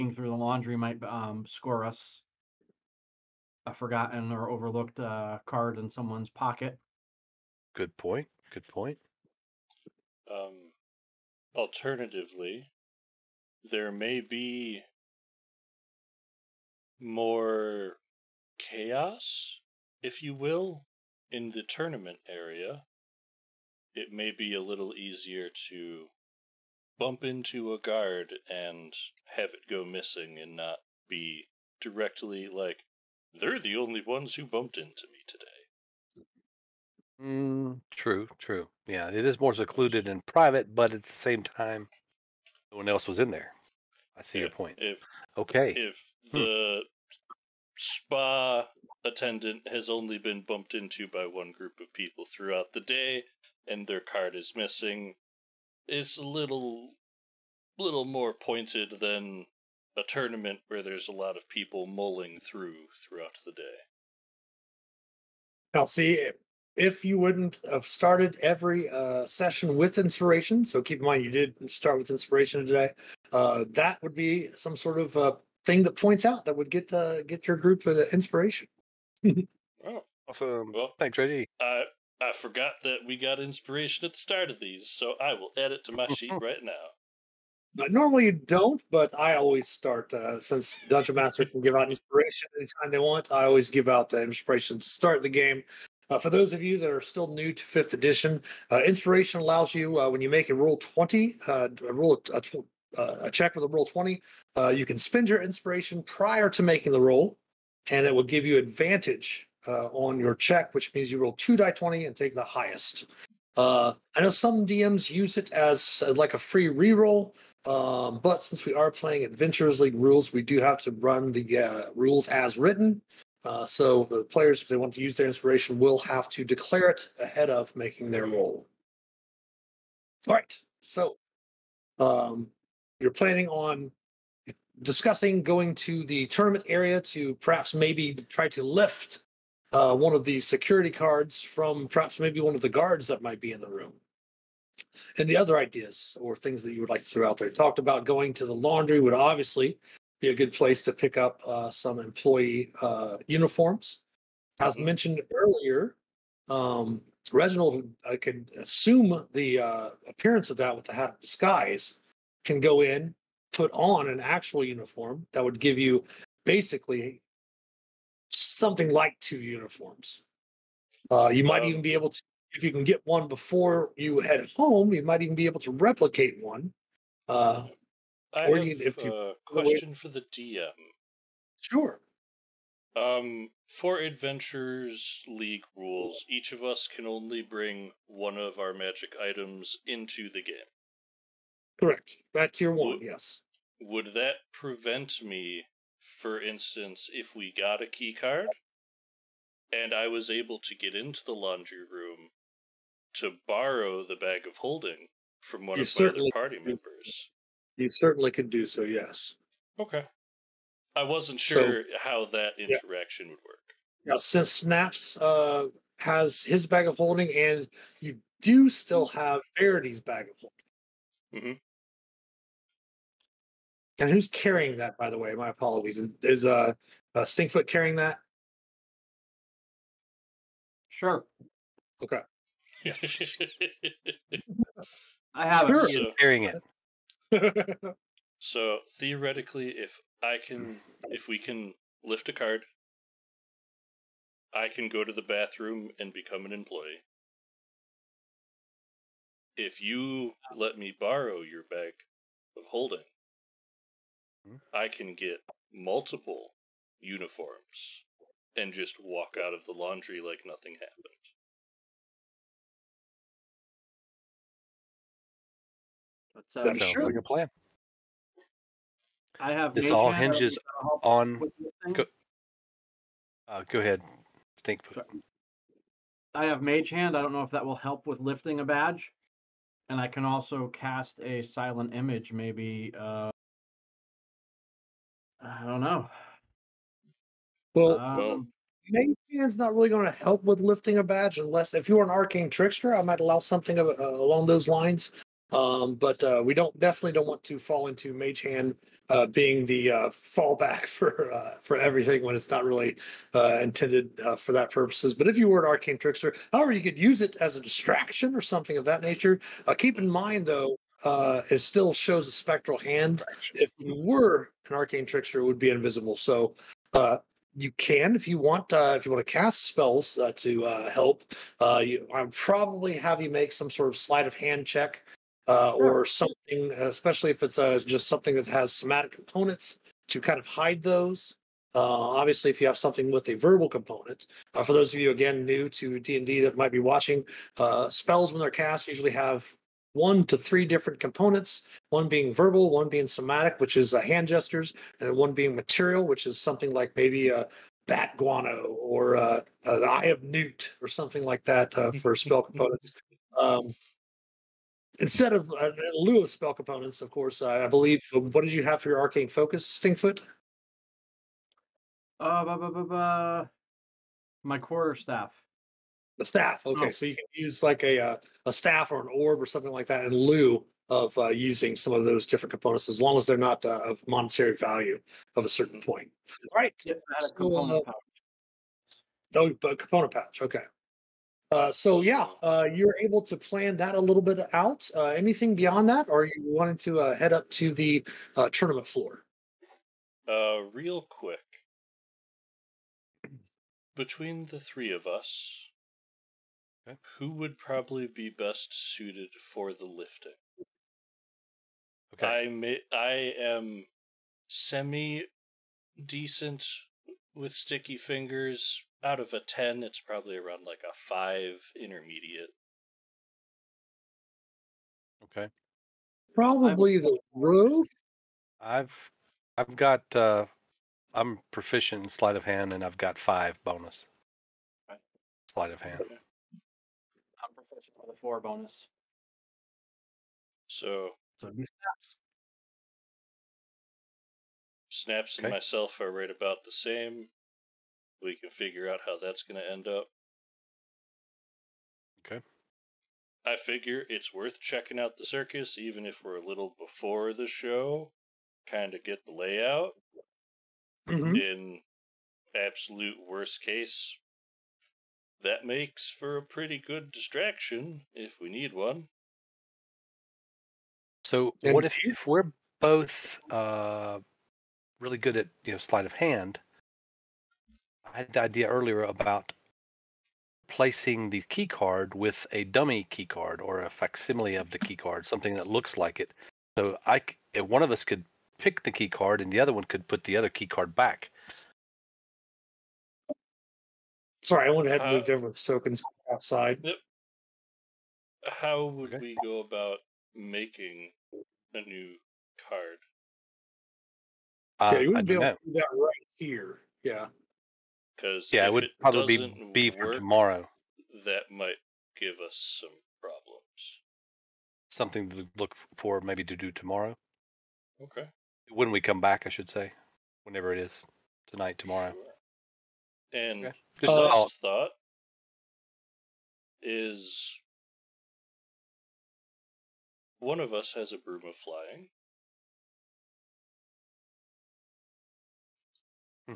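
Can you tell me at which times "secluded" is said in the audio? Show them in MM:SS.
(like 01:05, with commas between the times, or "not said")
00:39.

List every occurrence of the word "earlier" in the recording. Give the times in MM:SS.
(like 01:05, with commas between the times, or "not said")
02:35, 07:48.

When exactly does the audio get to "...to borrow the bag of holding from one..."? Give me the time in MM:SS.
03:23.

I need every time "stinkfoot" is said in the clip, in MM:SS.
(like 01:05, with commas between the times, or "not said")
03:47, 05:59.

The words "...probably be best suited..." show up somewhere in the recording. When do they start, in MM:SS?
06:37.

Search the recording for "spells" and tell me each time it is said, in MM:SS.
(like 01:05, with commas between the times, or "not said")
05:19, 05:37, 05:52, 05:56.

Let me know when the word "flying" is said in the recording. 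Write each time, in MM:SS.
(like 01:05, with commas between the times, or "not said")
08:41.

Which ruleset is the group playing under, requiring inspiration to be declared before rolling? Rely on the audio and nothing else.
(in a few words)
Adventurers League.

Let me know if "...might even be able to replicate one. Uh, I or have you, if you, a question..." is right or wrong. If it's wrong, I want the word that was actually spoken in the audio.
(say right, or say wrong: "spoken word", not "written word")
right.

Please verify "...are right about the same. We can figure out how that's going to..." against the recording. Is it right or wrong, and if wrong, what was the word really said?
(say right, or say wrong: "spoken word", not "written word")
right.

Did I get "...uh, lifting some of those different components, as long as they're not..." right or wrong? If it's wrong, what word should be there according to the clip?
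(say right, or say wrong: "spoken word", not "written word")
wrong: "using", not "lifting".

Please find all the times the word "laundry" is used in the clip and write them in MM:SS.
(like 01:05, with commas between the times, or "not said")
00:00, 02:28, 03:21, 04:19.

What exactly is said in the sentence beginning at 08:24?
Something to look for, maybe to do tomorrow.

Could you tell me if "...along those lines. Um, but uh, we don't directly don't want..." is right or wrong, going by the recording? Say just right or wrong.
wrong.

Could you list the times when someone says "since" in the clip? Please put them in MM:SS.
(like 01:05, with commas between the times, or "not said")
01:30, 01:58, 03:34.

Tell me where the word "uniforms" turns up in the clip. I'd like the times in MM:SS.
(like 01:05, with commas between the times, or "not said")
02:33, 02:44, 02:49, 04:16.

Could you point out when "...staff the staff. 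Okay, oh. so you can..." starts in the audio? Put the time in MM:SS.
06:04.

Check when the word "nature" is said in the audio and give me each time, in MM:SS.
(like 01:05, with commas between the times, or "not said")
05:09.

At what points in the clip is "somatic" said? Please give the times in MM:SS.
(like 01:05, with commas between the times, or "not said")
05:28, 05:43.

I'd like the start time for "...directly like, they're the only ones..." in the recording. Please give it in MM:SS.
00:31.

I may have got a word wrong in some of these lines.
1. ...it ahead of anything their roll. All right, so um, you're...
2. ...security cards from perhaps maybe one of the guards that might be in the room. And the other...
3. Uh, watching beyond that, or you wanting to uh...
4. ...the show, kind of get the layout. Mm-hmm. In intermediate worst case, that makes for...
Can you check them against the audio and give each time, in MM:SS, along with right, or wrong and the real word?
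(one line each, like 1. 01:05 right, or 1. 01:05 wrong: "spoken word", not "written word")
1. 02:06 wrong: "making", not "anything"
2. 02:20 right
3. 06:24 wrong: "anything", not "watching"
4. 07:27 wrong: "absolute", not "intermediate".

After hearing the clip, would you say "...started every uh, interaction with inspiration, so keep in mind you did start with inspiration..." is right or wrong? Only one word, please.
wrong.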